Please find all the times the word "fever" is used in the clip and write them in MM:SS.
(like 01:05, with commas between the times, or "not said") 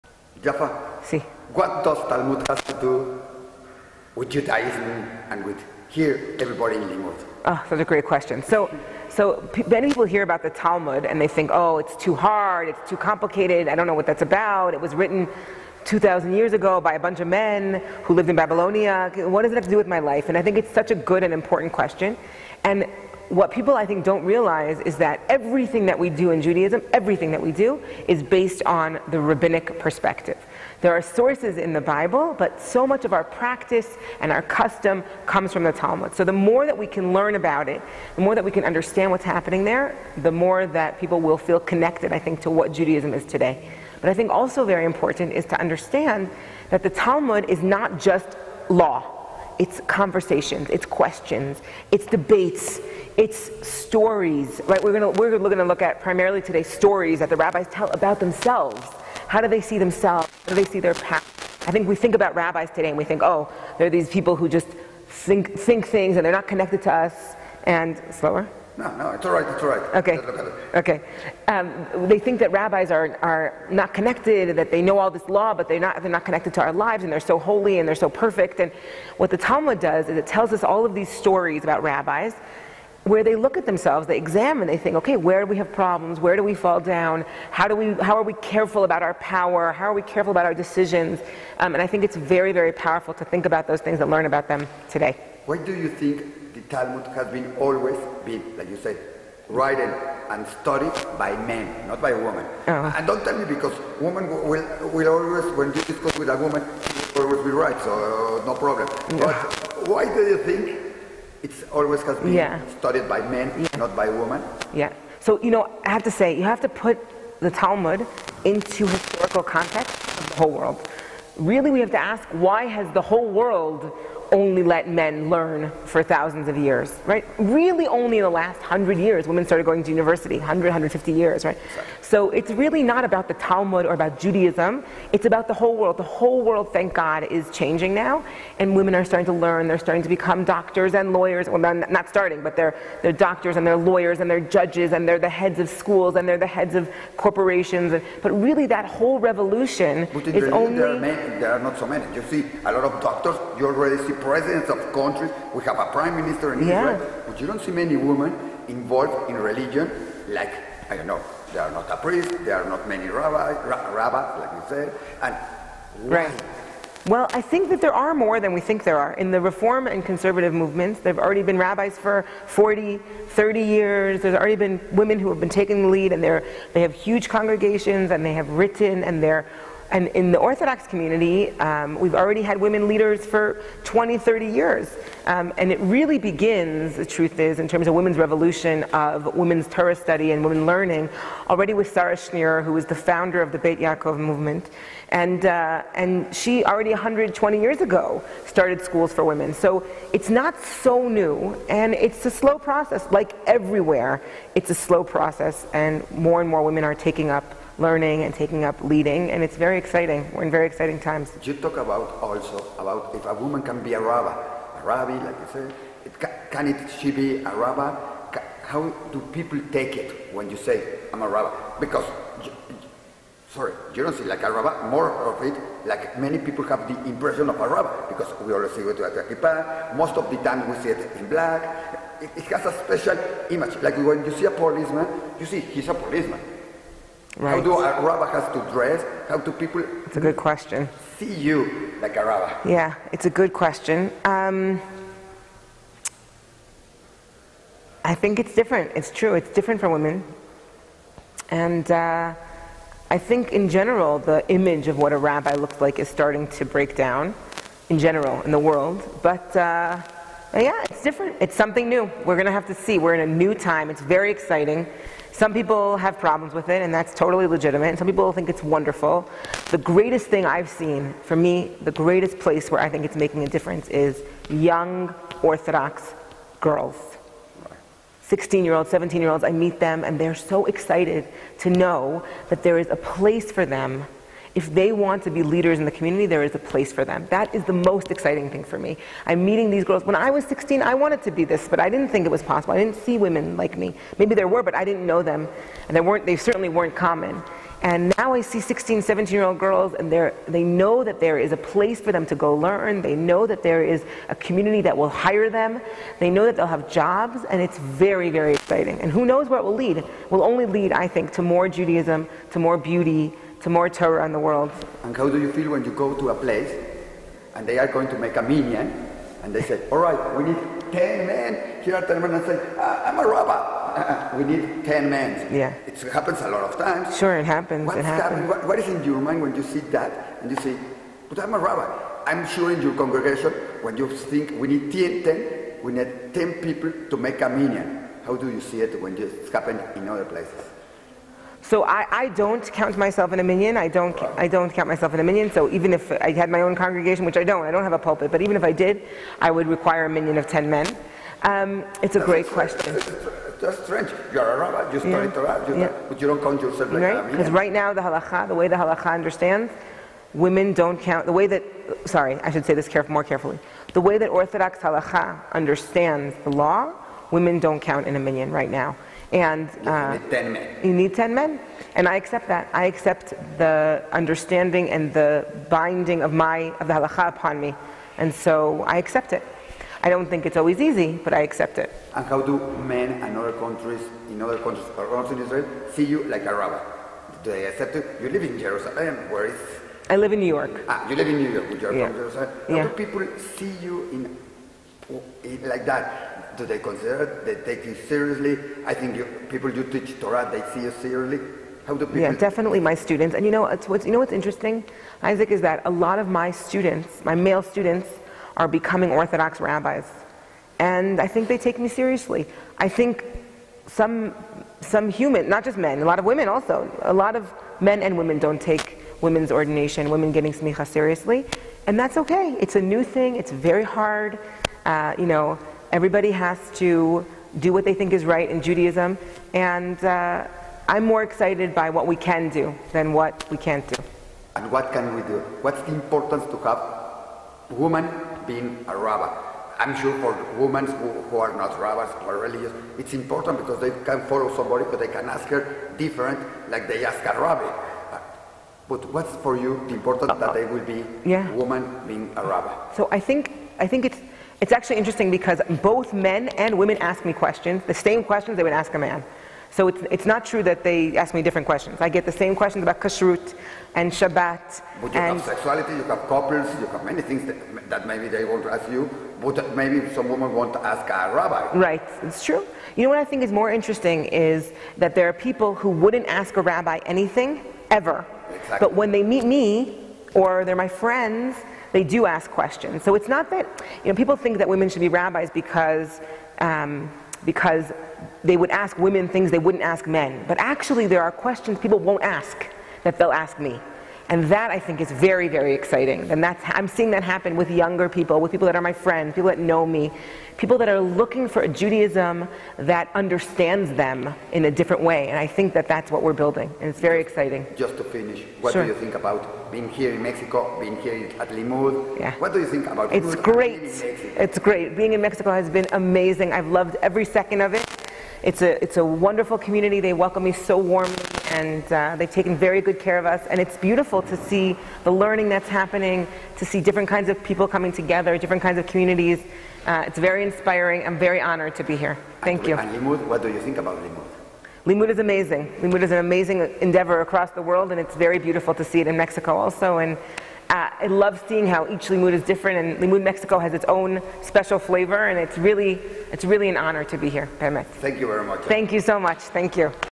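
not said.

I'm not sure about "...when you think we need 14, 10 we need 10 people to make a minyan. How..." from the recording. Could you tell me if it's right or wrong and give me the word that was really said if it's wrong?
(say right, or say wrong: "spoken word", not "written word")
wrong: "10", not "14".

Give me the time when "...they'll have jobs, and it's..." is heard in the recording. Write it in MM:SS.
05:06.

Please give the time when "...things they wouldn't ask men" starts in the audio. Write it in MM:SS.
08:09.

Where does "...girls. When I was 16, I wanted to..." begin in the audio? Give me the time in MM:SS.
04:49.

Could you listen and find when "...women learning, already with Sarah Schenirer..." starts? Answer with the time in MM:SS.
03:10.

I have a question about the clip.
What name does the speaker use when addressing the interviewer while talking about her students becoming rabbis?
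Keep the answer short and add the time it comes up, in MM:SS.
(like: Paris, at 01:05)
Isaac, at 06:45.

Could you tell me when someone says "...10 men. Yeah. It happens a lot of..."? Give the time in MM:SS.
05:24.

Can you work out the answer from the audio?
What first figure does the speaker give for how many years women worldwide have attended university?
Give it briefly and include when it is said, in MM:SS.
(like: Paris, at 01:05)
100, at 02:08.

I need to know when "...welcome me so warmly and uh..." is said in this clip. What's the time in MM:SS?
08:40.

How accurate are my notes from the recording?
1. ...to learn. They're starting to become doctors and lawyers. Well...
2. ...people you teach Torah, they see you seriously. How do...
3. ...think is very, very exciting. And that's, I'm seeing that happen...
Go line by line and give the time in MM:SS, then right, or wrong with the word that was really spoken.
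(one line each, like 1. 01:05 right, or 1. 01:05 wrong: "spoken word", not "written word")
1. 02:19 right
2. 06:39 right
3. 08:14 right.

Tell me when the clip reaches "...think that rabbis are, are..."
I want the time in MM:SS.
01:12.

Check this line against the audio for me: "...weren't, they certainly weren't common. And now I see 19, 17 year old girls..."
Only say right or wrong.
wrong.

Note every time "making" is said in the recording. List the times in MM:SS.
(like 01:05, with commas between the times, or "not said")
04:33.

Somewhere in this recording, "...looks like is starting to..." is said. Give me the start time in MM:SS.
04:15.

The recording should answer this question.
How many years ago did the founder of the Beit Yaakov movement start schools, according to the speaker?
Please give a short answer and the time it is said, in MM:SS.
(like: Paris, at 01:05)
120, at 03:16.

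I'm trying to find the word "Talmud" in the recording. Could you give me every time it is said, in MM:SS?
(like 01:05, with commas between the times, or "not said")
00:02, 00:10, 00:35, 00:46, 01:19, 01:36, 01:57, 02:13.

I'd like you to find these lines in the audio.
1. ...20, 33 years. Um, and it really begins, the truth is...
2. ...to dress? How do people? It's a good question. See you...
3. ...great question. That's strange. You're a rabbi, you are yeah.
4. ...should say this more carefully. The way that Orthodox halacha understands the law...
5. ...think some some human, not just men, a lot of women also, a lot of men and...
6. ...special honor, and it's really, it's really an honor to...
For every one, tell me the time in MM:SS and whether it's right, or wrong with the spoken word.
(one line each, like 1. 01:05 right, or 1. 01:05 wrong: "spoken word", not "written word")
1. 03:03 wrong: "30", not "33"
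2. 03:58 right
3. 05:52 right
4. 06:02 right
5. 06:52 right
6. 09:04 wrong: "flavor", not "honor".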